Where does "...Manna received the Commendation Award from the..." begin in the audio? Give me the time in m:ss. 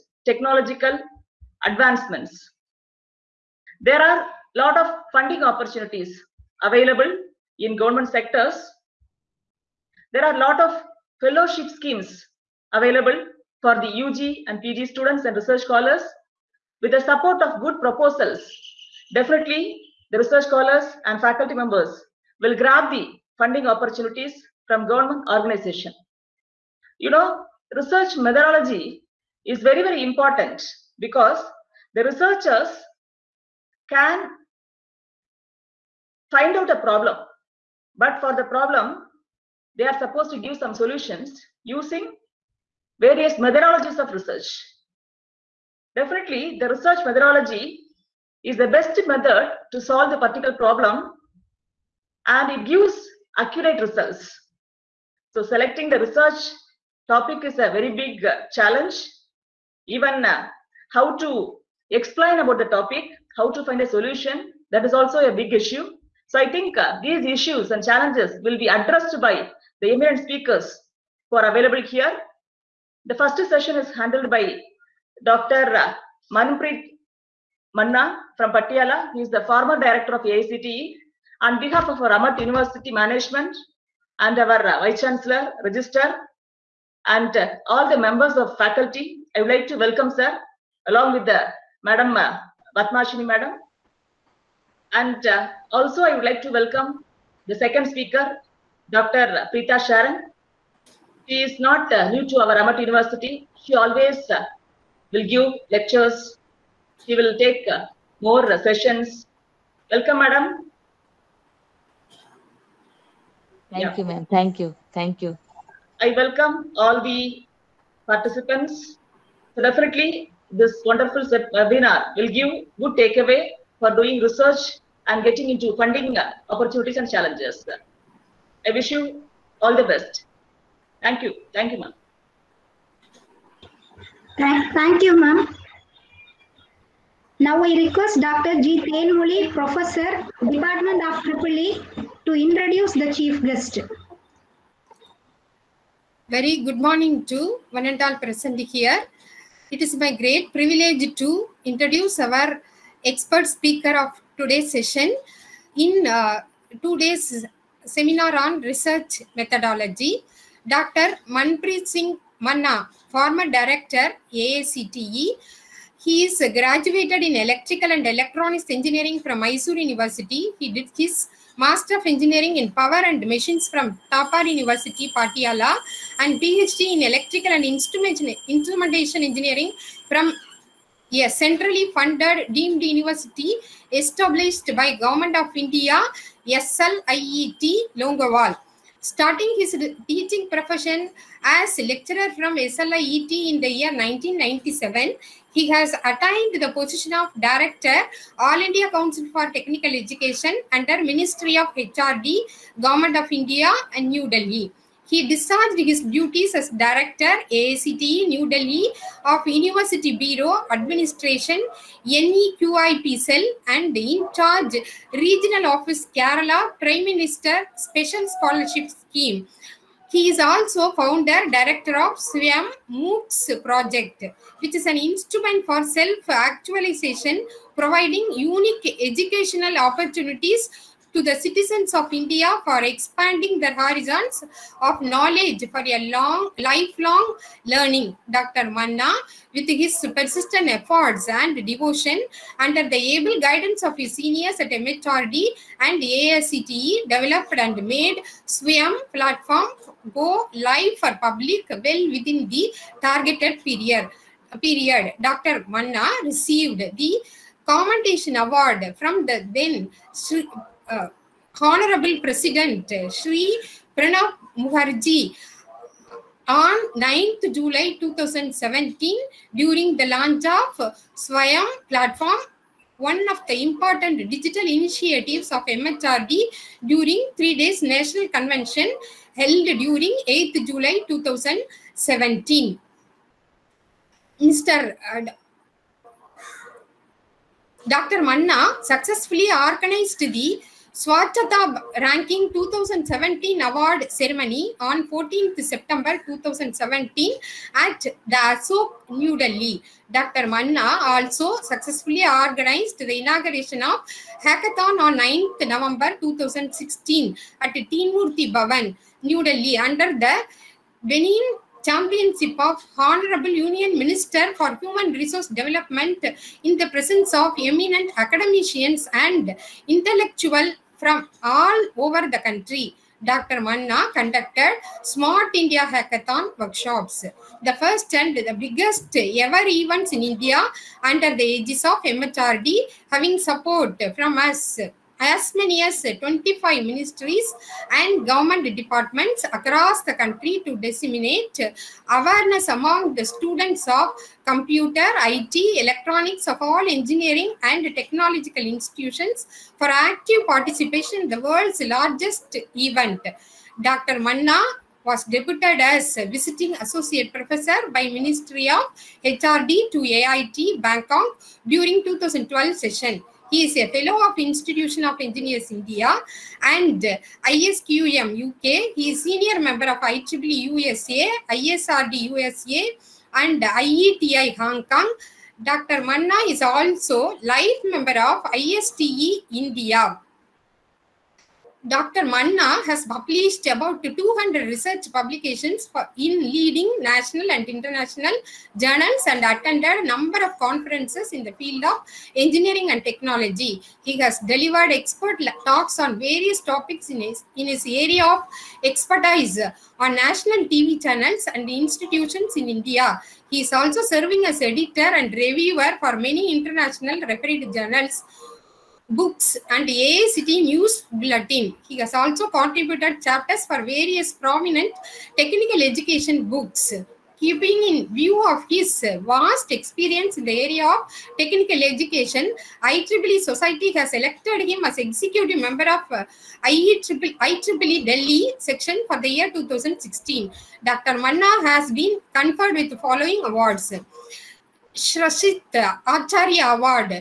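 4:15.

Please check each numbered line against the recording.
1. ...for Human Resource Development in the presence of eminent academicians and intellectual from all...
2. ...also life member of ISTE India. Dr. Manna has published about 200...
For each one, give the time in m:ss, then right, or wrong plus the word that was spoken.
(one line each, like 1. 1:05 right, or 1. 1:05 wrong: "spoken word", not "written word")
1. 5:14 right
2. 6:16 right.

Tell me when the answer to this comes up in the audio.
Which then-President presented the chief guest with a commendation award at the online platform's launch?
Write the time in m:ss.
4:23.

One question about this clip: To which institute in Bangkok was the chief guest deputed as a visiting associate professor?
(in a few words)
AIT.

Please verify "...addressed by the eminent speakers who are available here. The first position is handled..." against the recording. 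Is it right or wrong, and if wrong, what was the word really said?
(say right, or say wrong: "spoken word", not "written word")
wrong: "session", not "position".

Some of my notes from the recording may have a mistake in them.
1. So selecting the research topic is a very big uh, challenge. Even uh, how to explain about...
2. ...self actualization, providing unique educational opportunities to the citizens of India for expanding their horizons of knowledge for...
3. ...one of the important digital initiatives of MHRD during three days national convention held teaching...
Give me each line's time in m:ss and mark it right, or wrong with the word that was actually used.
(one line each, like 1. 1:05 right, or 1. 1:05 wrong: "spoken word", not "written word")
1. 0:55 right
2. 3:45 right
3. 4:32 wrong: "during", not "teaching".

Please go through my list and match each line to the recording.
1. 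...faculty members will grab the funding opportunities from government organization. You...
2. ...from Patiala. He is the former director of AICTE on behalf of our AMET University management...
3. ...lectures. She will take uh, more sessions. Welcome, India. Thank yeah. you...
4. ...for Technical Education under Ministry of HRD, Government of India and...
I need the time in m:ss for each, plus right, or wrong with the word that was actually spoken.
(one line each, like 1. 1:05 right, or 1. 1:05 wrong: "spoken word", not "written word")
1. 0:21 right
2. 1:18 right
3. 1:45 wrong: "Madam", not "India"
4. 3:19 right.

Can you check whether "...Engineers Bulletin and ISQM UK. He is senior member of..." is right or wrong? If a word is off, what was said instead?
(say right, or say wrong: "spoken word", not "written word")
wrong: "India", not "Bulletin".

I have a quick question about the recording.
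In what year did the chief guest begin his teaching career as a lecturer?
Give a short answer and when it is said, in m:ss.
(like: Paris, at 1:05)
1997, at 3:13.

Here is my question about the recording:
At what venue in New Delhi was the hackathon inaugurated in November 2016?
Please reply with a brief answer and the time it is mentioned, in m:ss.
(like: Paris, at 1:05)
Teen Murti Bhavan, at 5:07.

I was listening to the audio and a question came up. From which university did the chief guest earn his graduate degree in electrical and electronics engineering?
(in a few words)
Mysore University.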